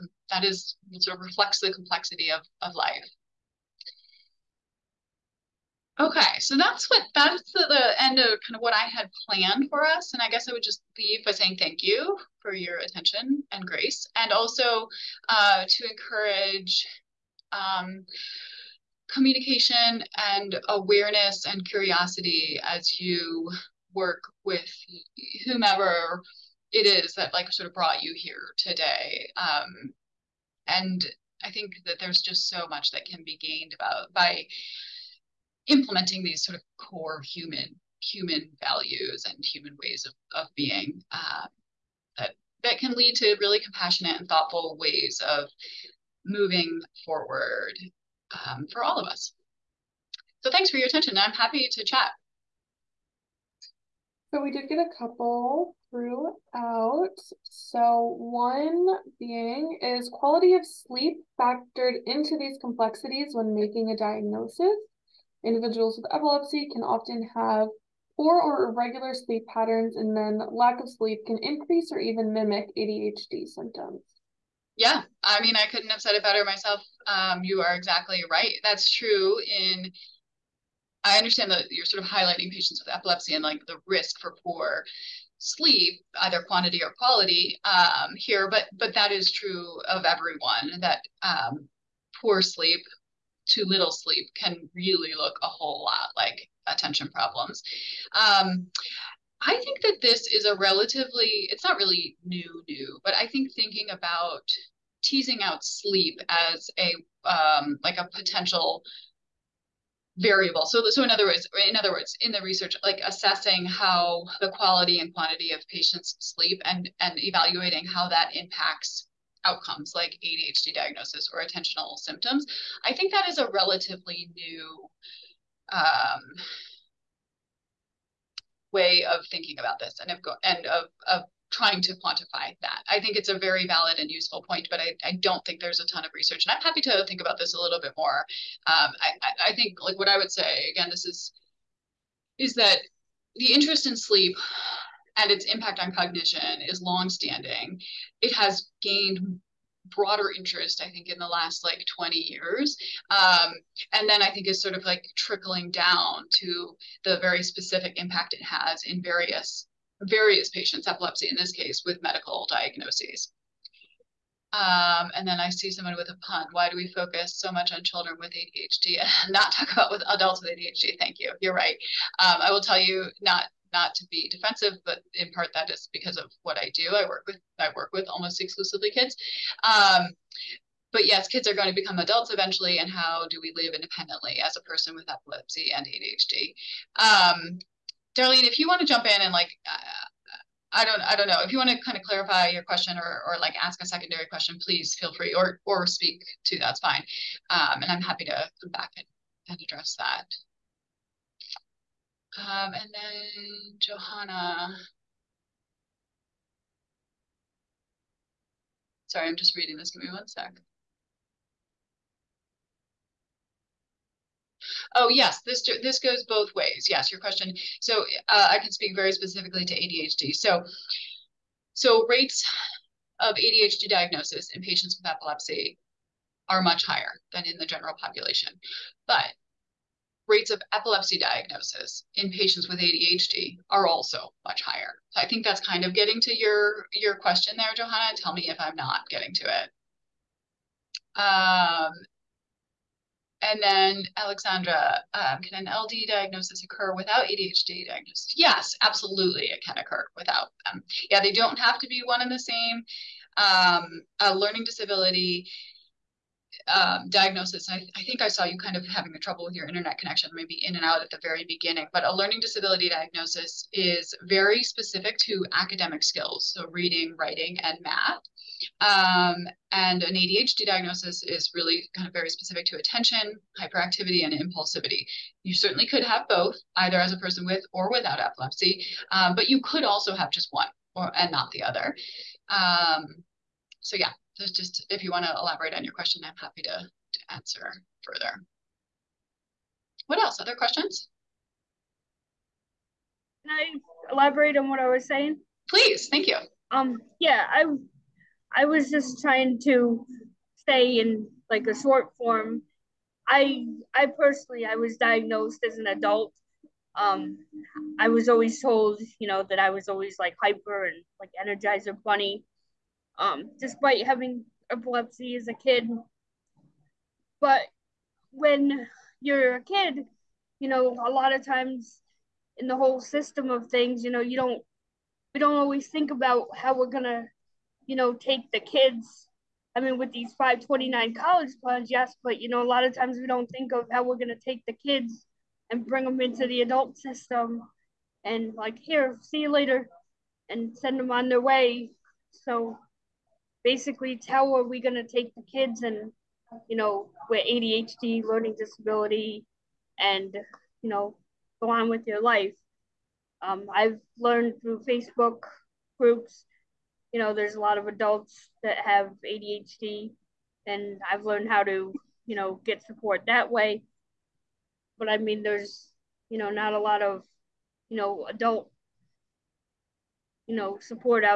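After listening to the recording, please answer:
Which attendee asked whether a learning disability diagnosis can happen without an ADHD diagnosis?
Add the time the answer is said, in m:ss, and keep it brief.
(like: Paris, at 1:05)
Alexandra, at 4:04.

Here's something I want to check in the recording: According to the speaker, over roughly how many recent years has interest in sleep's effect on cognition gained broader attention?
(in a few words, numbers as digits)
20 years.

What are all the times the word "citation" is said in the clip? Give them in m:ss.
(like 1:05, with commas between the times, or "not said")
not said.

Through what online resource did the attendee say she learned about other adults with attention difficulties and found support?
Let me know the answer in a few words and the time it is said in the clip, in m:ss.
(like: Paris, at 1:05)
Facebook groups, at 5:54.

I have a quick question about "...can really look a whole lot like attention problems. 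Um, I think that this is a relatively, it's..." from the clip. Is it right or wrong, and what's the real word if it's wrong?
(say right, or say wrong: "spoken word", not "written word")
right.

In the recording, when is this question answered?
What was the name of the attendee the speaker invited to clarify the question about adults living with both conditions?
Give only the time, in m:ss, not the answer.
3:08.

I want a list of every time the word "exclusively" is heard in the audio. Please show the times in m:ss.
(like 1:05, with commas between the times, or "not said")
2:58.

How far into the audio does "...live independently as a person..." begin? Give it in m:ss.
3:03.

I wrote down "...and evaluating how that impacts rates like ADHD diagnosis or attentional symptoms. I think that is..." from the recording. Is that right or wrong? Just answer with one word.
wrong.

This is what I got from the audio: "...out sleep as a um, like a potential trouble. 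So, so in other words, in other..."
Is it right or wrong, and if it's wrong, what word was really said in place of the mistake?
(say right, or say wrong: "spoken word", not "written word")
wrong: "variable", not "trouble".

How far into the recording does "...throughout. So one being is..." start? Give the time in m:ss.
0:55.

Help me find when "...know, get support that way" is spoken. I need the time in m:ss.
6:02.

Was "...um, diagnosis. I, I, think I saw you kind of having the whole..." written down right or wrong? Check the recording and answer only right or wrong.
wrong.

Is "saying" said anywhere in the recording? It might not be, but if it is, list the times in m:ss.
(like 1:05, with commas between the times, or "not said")
0:11, 4:55.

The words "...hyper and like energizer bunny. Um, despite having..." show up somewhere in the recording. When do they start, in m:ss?
5:10.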